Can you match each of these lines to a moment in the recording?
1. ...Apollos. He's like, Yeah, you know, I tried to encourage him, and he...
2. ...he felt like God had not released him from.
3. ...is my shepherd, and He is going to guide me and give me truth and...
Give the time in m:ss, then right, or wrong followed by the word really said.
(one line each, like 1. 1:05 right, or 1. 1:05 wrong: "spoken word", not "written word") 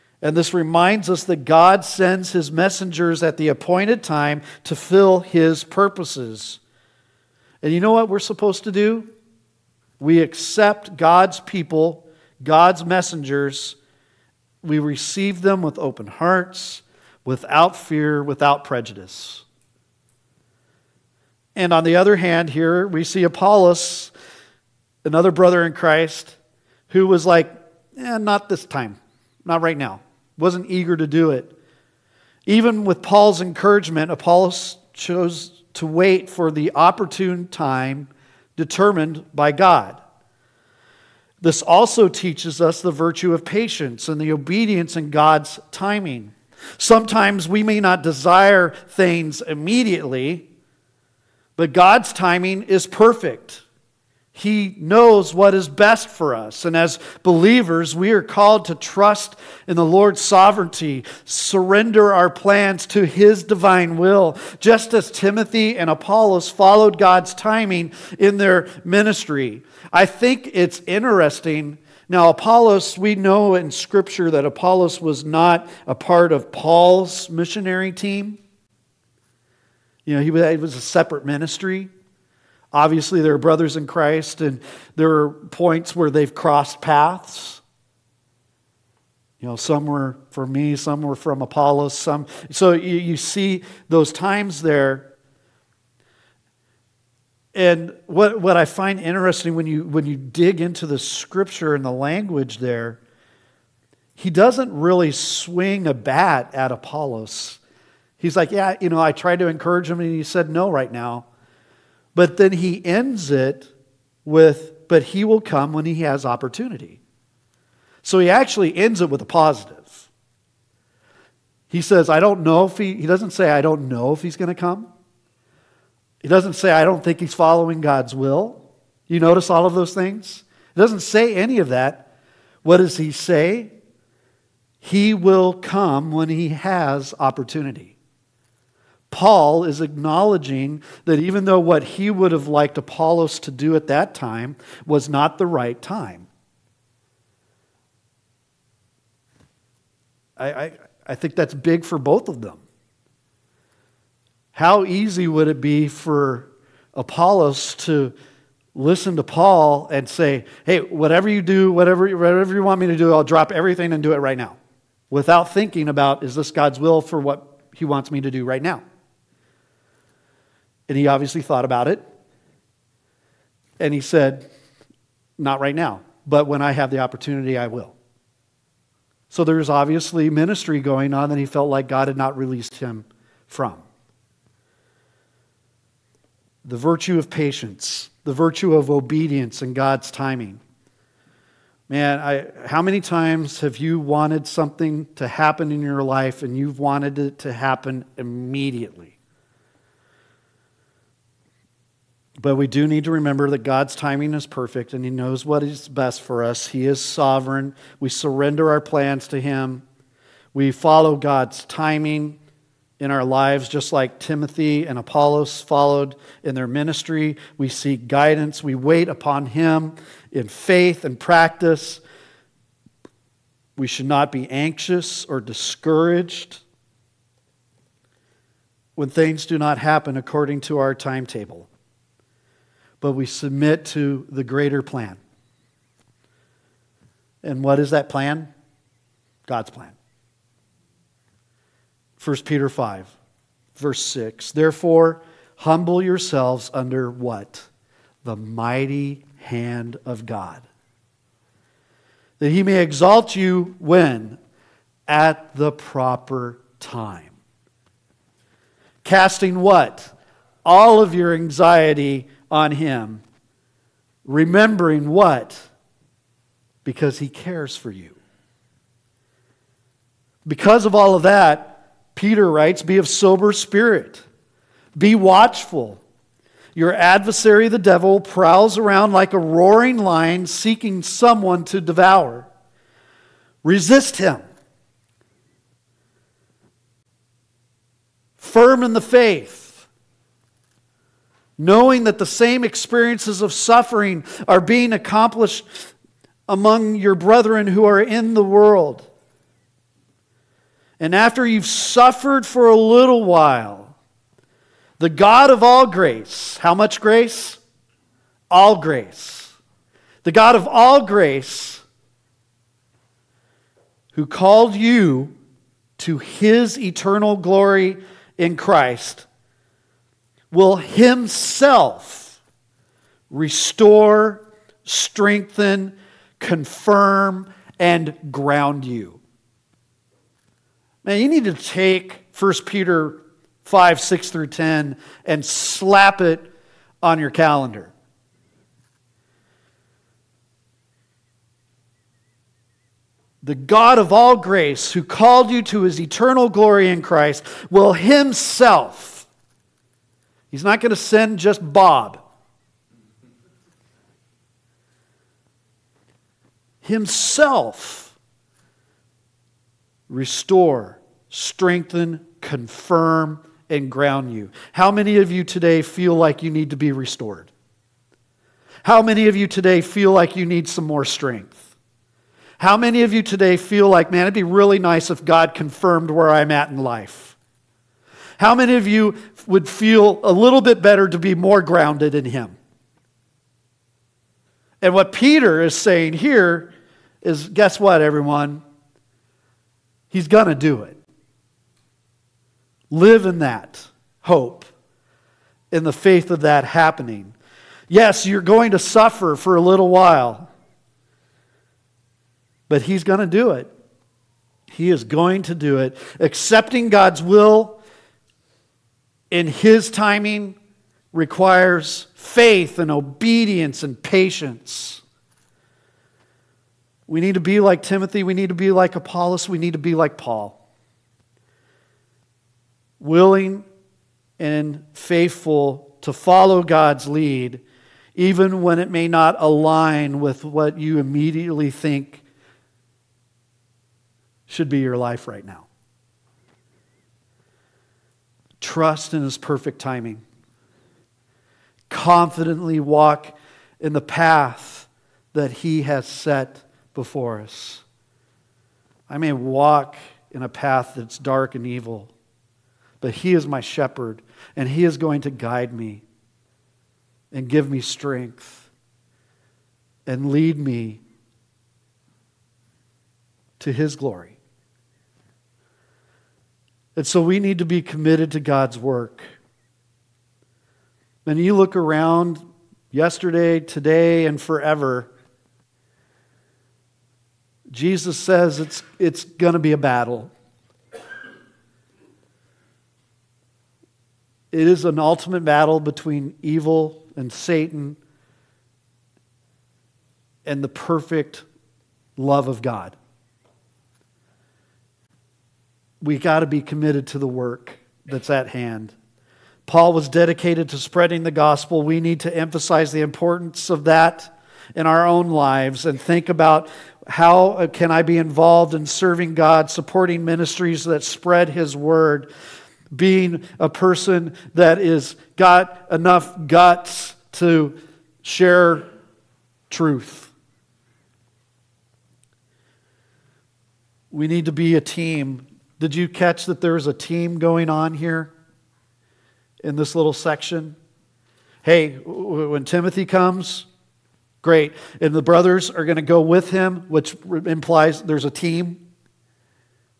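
1. 1:46 right
2. 3:01 right
3. 7:33 wrong: "strength", not "truth".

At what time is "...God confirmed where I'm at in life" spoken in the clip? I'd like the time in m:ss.
6:15.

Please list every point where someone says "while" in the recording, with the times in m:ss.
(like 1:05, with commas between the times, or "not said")
5:03, 6:39.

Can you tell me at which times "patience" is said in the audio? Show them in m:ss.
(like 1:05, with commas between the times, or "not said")
0:43, 3:07, 6:53.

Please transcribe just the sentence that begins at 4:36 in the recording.
Your adversary, the devil, prowls around like a roaring lion seeking someone to devour.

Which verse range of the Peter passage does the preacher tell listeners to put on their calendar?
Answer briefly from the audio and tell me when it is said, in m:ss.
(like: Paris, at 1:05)
6 through 10, at 5:33.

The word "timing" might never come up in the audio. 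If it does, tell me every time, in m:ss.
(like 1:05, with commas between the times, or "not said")
0:45, 0:52, 1:07, 3:10, 3:23, 3:31, 6:49, 7:19.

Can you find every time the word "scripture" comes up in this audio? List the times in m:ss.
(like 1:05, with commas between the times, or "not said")
1:13, 1:40.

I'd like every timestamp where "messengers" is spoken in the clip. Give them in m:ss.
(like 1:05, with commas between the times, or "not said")
0:02, 0:12.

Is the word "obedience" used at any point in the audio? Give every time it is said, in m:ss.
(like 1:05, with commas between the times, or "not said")
0:44, 3:08, 6:52.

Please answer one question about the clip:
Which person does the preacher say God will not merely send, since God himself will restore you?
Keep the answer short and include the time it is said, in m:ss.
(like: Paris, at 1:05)
Bob, at 5:51.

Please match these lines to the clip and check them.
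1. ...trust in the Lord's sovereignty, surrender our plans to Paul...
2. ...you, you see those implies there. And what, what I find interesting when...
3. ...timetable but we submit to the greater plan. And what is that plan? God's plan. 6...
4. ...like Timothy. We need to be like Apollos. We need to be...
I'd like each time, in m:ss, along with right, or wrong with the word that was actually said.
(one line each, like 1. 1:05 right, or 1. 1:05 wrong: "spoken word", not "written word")
1. 0:58 wrong: "His", not "Paul"
2. 1:32 wrong: "times", not "implies"
3. 3:50 wrong: "1", not "6"
4. 6:57 right.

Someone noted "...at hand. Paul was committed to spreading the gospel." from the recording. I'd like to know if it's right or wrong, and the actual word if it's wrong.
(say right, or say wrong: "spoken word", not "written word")
wrong: "dedicated", not "committed".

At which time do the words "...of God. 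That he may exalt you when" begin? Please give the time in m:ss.
4:10.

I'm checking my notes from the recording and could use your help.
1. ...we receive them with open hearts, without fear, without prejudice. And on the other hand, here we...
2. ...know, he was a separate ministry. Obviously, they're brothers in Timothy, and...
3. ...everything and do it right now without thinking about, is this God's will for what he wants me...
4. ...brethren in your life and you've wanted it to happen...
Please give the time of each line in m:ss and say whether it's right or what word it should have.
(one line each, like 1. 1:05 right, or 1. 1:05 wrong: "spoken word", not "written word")
1. 0:14 right
2. 1:20 wrong: "Christ", not "Timothy"
3. 2:43 right
4. 3:15 wrong: "happen", not "brethren".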